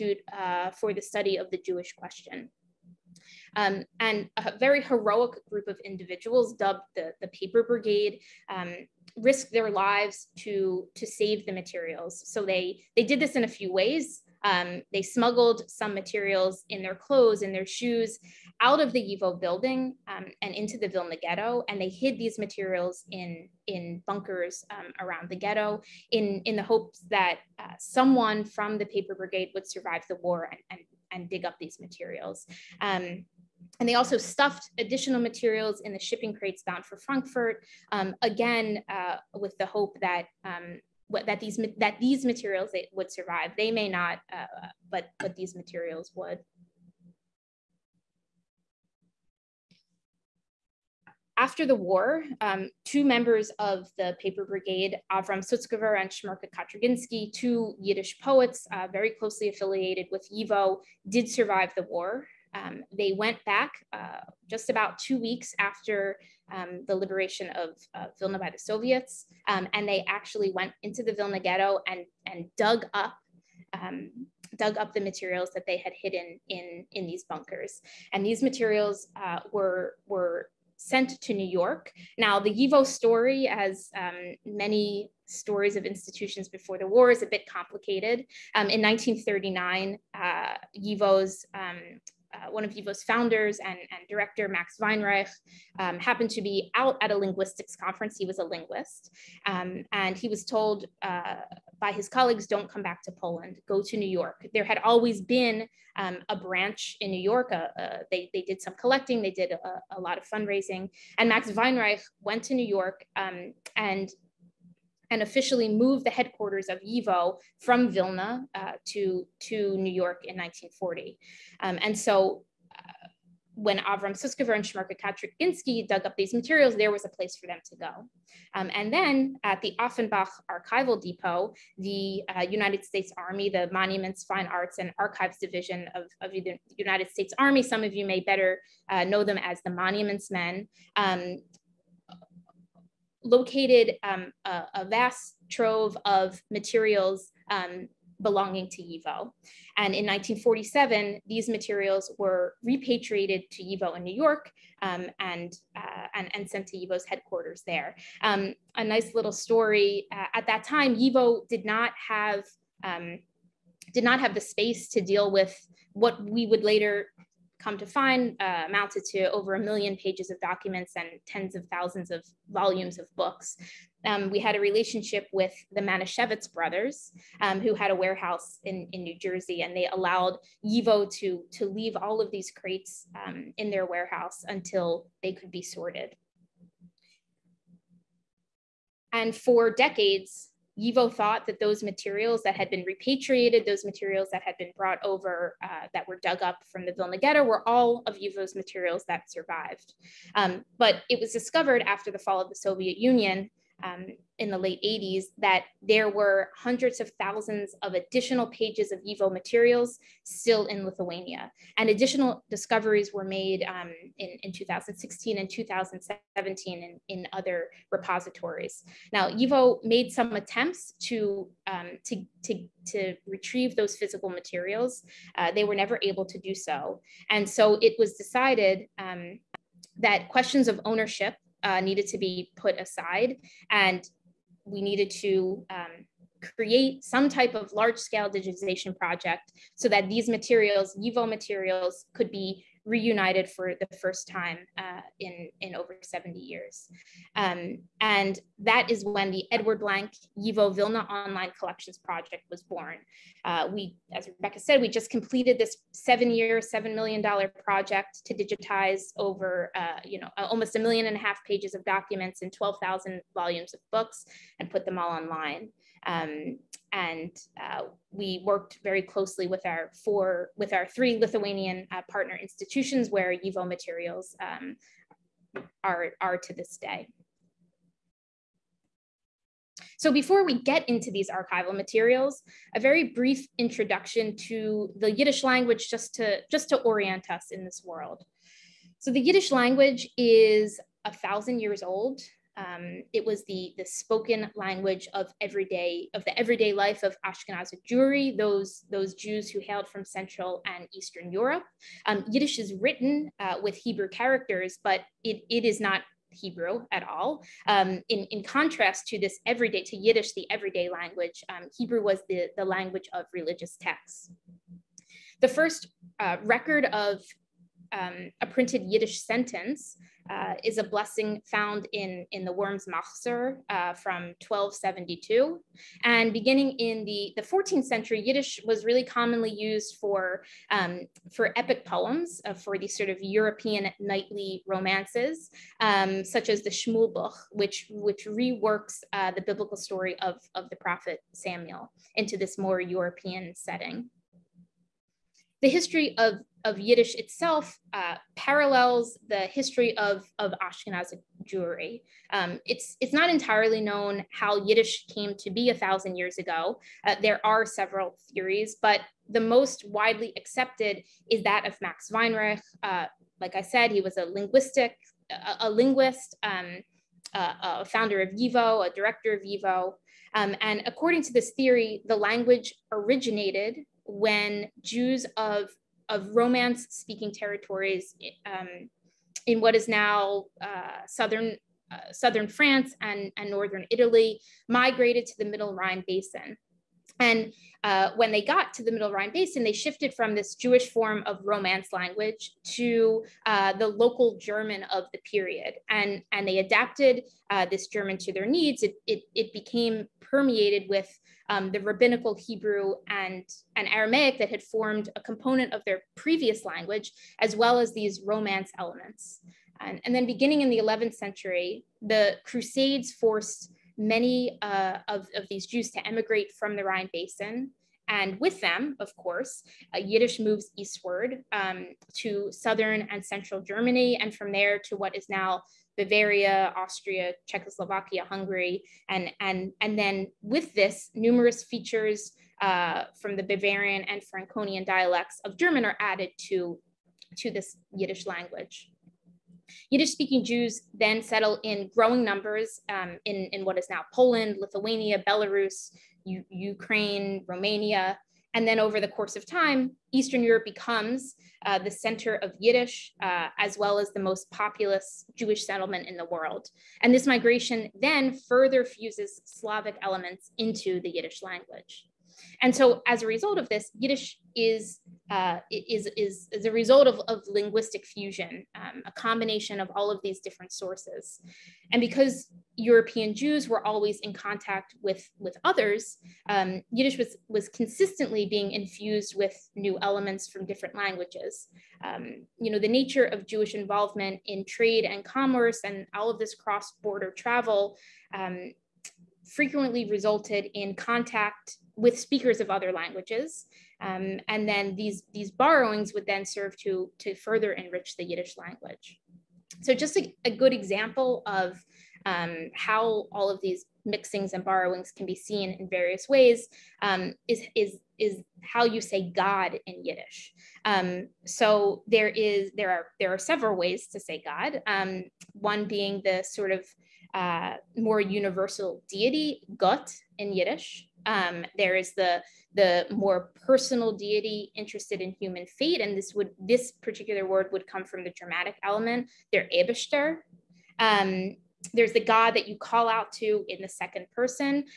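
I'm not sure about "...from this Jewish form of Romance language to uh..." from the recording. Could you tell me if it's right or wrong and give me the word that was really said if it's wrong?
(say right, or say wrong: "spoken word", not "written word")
right.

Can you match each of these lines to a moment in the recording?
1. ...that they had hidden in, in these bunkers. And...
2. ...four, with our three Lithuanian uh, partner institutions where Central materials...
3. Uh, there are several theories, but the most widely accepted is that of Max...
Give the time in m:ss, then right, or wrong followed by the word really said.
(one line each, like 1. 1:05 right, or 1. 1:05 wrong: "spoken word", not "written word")
1. 1:15 right
2. 4:30 wrong: "YIVO", not "Central"
3. 5:57 right.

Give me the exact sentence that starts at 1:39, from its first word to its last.
Um, and he was told uh, by his colleagues, don't come back to Poland, go to New York.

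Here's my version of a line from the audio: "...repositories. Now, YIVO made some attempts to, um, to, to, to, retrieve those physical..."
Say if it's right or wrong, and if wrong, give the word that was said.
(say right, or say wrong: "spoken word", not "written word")
right.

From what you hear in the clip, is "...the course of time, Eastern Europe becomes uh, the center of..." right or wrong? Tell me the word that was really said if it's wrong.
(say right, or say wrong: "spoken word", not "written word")
right.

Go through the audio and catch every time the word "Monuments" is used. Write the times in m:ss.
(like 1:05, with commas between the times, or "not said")
2:13, 2:19.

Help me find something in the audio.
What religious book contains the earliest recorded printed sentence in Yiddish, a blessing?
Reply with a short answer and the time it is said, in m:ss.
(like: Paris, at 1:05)
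Worms Machzor, at 5:22.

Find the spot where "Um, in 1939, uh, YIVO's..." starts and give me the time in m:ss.
1:28.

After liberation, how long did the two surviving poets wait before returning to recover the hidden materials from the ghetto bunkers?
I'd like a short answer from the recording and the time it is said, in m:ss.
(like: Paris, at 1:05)
2 weeks, at 1:04.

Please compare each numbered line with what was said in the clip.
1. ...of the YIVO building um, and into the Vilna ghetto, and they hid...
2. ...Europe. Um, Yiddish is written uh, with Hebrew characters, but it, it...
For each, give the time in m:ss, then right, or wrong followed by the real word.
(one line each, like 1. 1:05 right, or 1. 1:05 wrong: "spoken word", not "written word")
1. 0:18 right
2. 5:01 right.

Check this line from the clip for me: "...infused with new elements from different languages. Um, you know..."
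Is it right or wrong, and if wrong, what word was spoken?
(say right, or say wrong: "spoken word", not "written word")
right.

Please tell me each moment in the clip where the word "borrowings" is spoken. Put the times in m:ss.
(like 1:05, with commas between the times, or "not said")
8:15, 8:24.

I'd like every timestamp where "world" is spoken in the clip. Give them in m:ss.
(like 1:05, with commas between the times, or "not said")
4:47, 7:36.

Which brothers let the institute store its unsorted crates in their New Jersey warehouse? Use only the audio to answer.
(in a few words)
Manischewitz brothers.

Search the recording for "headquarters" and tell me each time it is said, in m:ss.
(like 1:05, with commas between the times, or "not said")
1:56, 2:37.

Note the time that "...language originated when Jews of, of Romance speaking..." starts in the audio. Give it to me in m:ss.
6:12.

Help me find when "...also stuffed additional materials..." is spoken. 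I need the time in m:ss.
0:33.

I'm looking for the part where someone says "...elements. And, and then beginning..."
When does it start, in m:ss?
6:48.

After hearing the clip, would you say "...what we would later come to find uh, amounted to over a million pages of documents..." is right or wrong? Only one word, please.
right.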